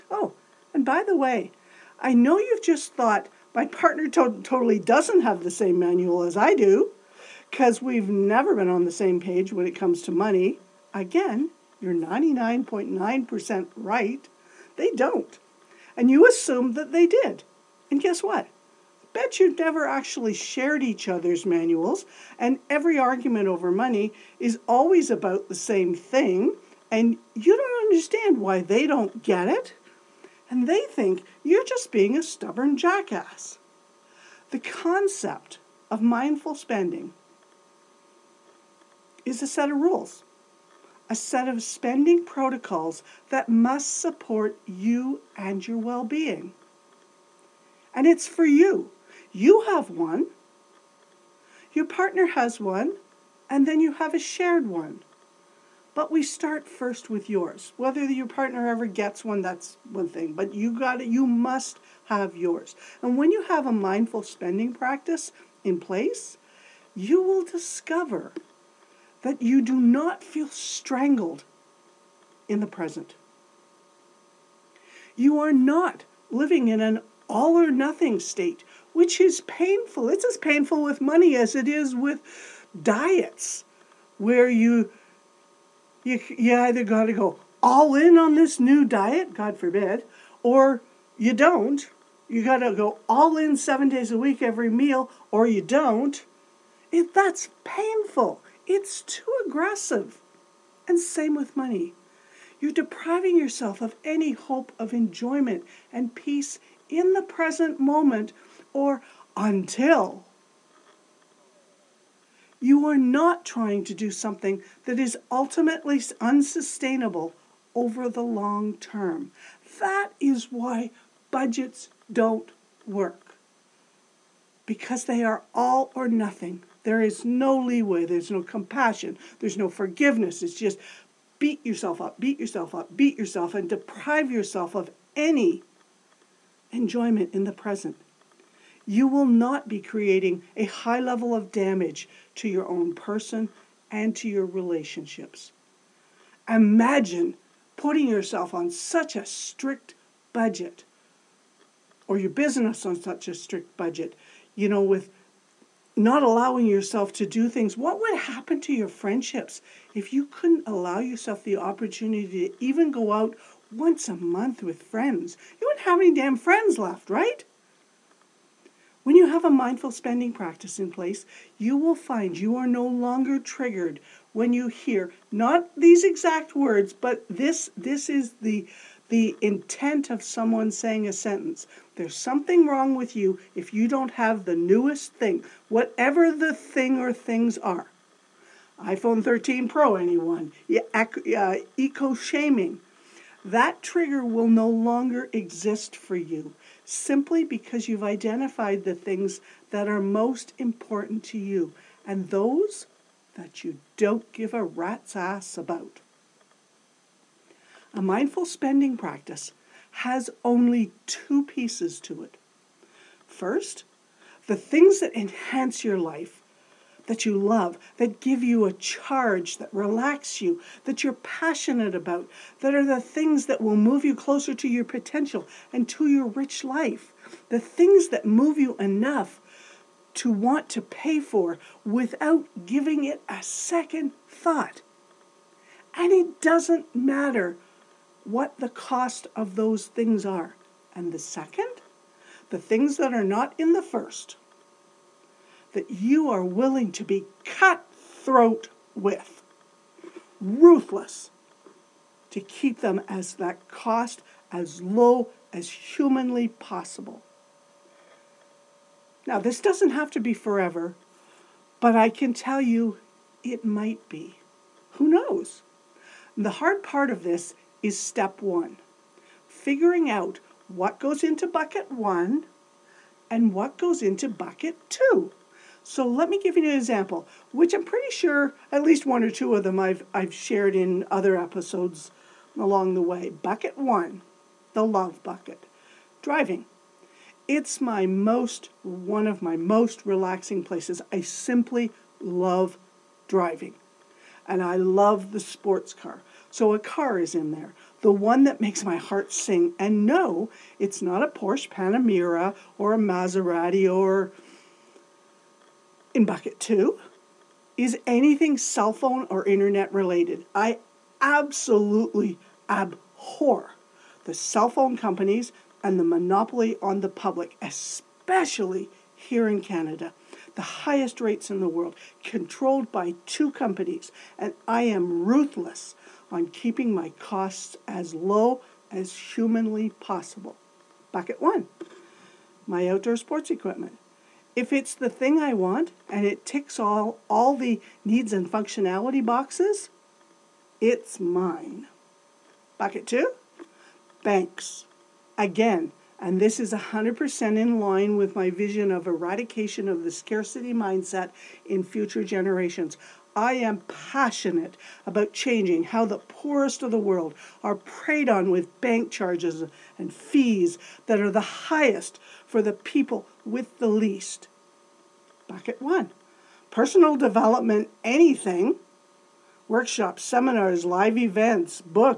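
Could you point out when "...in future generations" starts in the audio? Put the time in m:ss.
5:51.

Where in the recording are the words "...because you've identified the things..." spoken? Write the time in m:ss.
3:17.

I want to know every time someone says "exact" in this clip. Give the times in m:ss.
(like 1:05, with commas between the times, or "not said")
2:56.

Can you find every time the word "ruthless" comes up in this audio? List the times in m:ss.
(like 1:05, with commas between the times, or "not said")
4:10, 5:25.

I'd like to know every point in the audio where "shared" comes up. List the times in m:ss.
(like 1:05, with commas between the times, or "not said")
0:20, 0:54, 4:40.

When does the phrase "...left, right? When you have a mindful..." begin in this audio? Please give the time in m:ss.
2:46.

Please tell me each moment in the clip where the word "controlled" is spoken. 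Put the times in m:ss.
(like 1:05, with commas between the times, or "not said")
5:22.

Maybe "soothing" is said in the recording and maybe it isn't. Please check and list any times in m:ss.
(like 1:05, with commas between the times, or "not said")
not said.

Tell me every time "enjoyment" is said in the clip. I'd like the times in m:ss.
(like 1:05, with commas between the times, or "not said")
1:44, 2:16.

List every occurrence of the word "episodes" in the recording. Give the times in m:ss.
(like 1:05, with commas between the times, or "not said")
4:41.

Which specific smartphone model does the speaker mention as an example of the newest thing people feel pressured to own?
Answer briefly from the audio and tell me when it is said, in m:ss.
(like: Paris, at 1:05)
iPhone 13 Pro, at 3:08.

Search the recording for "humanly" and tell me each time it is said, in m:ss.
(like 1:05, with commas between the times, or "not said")
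4:15, 5:29.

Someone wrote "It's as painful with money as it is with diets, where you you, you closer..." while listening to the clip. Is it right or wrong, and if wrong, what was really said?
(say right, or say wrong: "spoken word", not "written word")
wrong: "either", not "closer".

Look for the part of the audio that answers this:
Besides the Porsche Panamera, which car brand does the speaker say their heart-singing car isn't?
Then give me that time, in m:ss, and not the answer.
5:02.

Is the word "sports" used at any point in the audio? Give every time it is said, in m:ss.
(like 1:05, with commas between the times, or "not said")
4:55, 5:33.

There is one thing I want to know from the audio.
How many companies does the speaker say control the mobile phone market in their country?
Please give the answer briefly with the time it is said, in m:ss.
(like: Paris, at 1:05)
2, at 5:23.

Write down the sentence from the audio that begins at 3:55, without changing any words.
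And it doesn't matter what the cost of those things are.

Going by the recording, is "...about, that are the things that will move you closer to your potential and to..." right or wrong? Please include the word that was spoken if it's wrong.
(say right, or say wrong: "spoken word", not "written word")
right.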